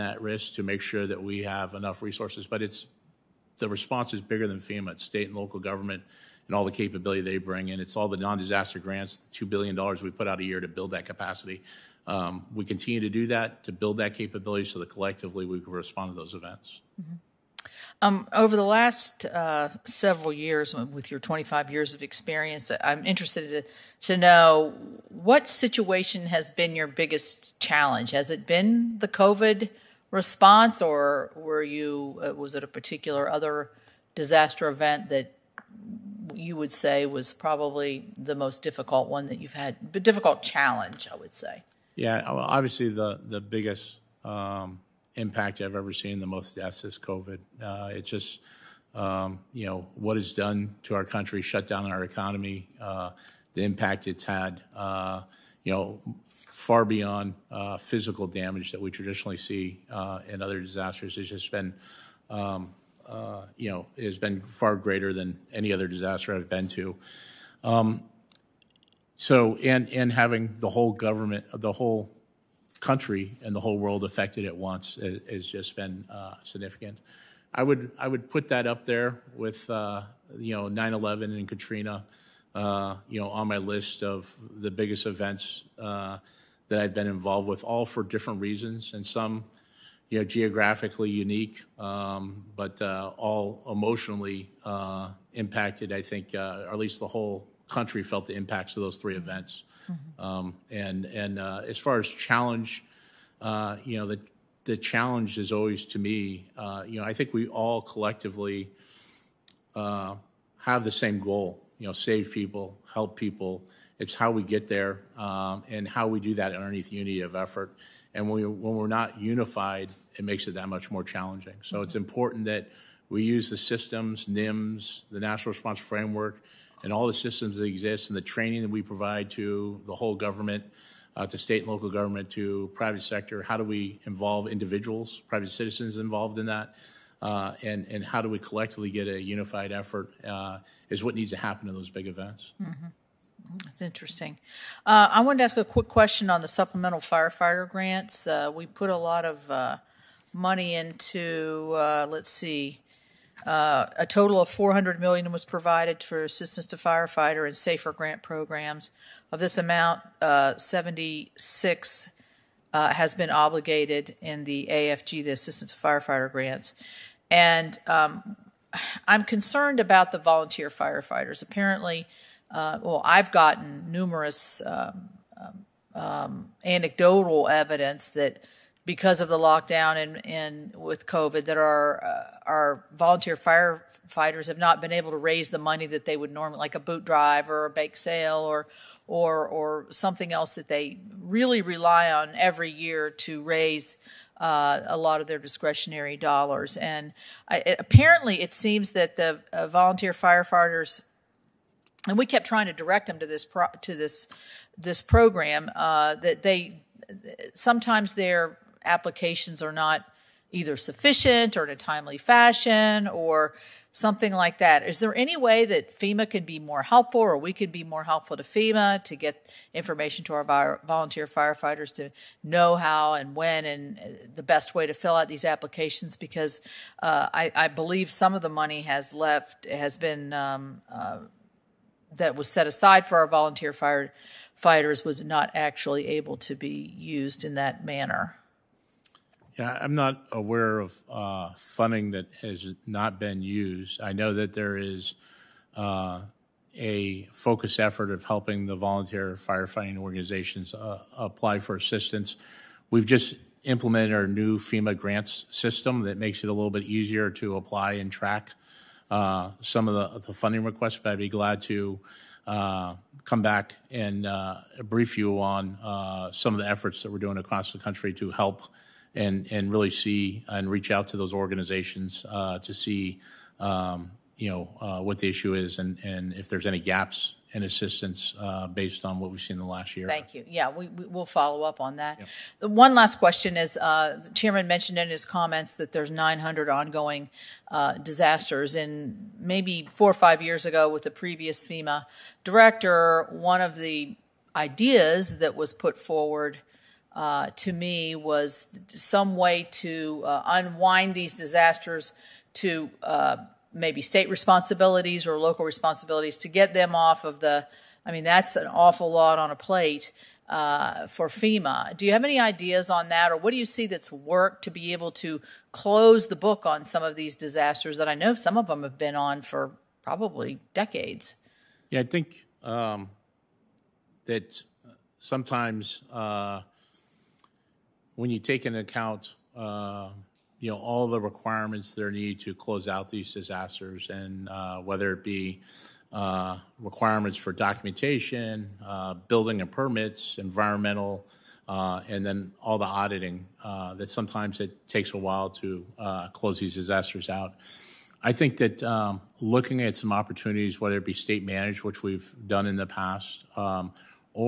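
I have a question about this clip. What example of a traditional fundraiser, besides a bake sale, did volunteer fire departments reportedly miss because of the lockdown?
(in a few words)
boot drive.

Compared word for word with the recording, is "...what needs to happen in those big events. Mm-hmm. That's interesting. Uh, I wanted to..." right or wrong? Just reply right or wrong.
right.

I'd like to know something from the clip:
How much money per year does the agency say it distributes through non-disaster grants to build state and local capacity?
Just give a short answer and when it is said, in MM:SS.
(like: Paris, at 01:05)
$2 billion, at 00:09.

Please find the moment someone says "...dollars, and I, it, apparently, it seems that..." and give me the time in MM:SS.
03:16.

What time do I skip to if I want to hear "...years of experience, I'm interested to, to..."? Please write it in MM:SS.
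00:21.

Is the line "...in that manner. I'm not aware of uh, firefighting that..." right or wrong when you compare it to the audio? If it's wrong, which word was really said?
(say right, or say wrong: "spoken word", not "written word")
wrong: "funding", not "firefighting".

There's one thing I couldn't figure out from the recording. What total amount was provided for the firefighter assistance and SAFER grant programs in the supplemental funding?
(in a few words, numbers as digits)
$400 million.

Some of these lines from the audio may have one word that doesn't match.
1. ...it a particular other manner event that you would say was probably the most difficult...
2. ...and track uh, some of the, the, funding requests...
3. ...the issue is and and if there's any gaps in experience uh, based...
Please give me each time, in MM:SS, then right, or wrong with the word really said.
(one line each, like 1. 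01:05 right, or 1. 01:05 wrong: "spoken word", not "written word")
1. 00:32 wrong: "disaster", not "manner"
2. 04:17 right
3. 04:35 wrong: "assistance", not "experience".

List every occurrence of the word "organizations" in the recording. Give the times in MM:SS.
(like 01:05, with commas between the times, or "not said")
04:09, 04:31.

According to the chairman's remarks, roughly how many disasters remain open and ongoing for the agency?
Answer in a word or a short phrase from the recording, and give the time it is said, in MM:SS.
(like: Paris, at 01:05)
900, at 04:46.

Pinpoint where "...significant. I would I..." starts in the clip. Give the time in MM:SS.
01:16.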